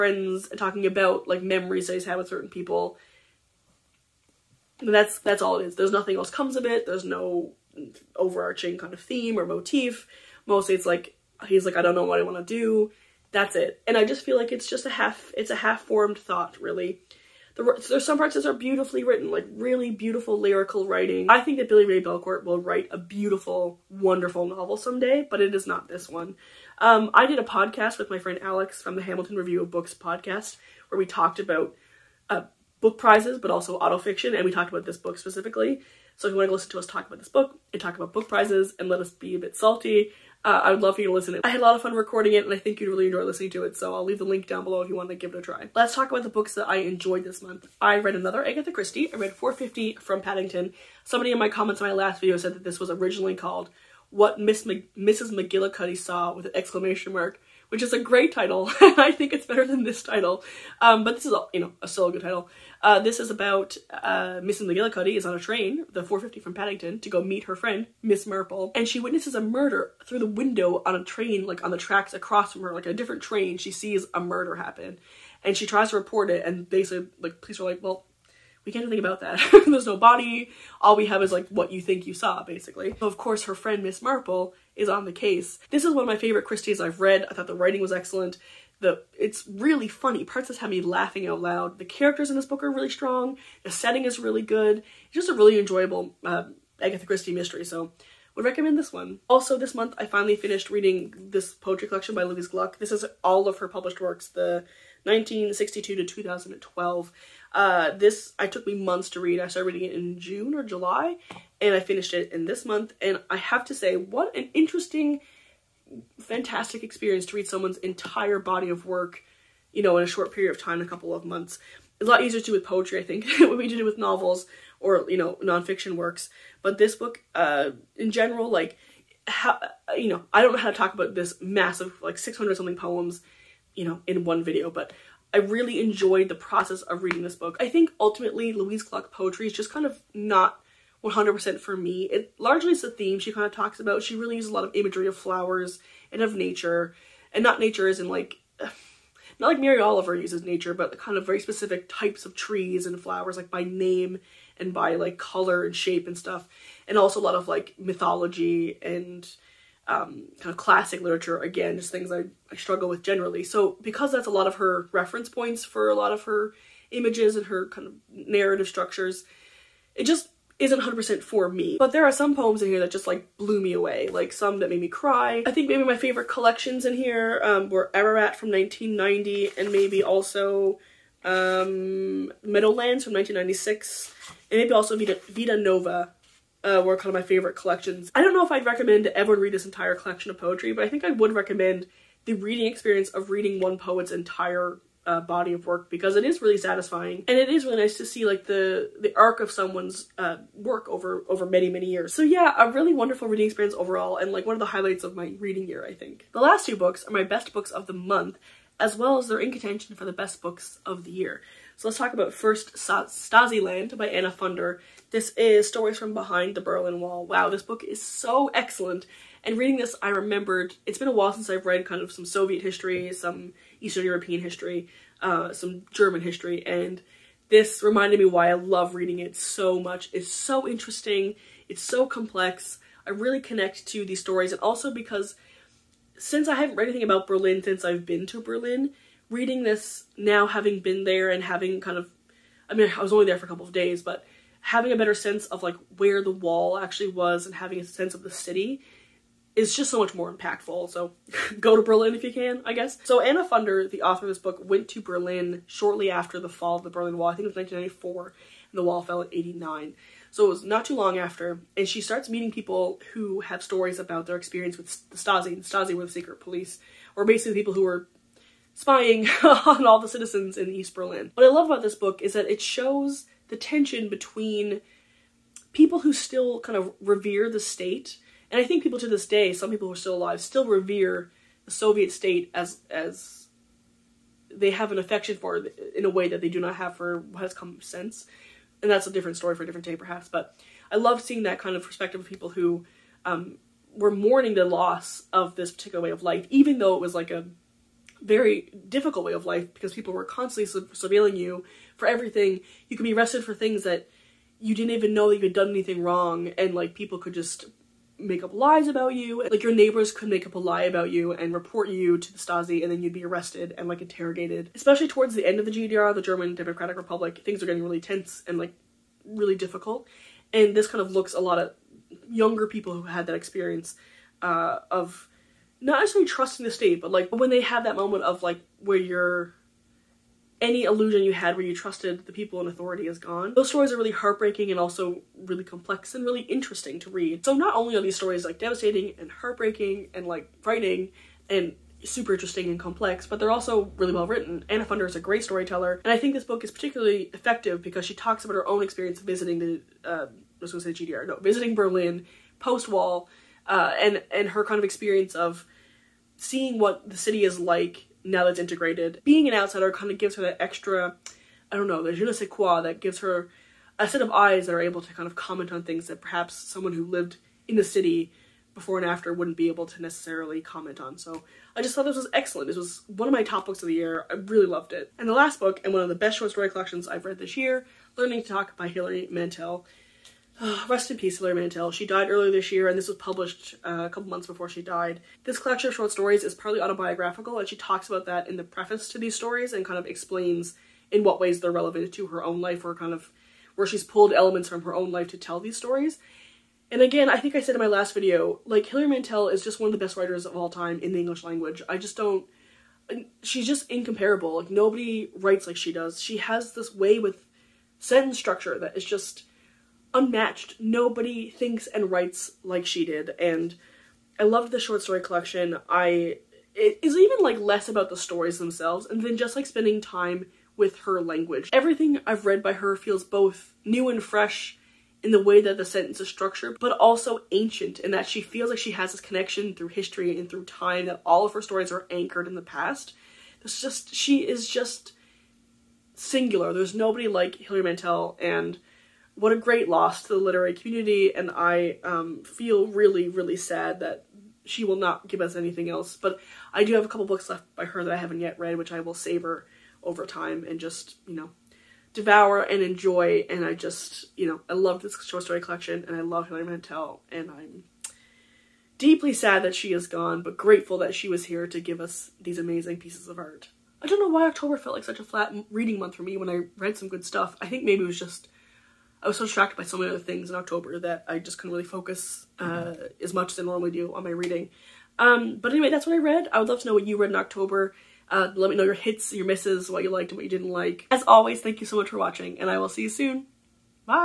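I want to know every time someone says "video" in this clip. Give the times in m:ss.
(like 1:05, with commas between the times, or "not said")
0:52, 2:14, 6:38.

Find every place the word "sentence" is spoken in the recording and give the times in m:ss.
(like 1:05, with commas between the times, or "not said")
6:47, 7:05.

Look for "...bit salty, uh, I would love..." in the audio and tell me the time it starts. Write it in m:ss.
0:39.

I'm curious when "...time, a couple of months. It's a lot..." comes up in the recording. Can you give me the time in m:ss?
2:00.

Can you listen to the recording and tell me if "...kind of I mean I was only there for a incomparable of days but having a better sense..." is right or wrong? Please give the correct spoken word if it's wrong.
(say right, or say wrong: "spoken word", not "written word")
wrong: "couple", not "incomparable".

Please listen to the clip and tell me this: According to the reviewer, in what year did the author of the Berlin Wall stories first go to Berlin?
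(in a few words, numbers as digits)
1994.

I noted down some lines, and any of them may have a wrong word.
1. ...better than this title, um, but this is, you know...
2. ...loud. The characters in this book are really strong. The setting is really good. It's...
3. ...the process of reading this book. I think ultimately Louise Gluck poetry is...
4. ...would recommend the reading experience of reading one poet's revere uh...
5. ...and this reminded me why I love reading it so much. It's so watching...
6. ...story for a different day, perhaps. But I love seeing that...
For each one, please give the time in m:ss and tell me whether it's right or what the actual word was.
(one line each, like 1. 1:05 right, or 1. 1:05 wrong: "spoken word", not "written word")
1. 0:59 right
2. 1:31 right
3. 2:16 right
4. 3:11 wrong: "entire", not "revere"
5. 3:46 wrong: "interesting", not "watching"
6. 4:49 right.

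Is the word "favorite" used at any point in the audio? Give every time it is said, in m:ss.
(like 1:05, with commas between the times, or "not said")
1:26, 2:55, 3:07.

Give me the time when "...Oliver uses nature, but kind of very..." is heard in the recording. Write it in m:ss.
2:29.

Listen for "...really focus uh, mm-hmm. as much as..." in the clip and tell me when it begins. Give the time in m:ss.
7:51.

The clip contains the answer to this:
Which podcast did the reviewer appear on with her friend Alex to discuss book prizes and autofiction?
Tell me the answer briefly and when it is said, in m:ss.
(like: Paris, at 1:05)
Hamilton Review of Books, at 0:29.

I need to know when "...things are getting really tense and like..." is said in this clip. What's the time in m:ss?
5:17.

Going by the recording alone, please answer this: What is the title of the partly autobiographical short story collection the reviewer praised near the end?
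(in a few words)
Learning to Talk.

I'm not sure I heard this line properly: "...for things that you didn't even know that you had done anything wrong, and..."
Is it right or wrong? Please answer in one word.
right.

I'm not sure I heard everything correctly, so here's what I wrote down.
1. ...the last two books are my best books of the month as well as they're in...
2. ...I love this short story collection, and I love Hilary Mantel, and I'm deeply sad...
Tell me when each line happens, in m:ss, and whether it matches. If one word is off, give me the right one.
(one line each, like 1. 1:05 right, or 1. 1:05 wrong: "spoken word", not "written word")
1. 3:26 right
2. 7:34 right.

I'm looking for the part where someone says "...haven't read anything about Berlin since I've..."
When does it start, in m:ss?
3:56.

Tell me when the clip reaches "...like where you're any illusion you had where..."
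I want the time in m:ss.
5:28.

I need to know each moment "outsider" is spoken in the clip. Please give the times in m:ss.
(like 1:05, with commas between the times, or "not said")
5:59.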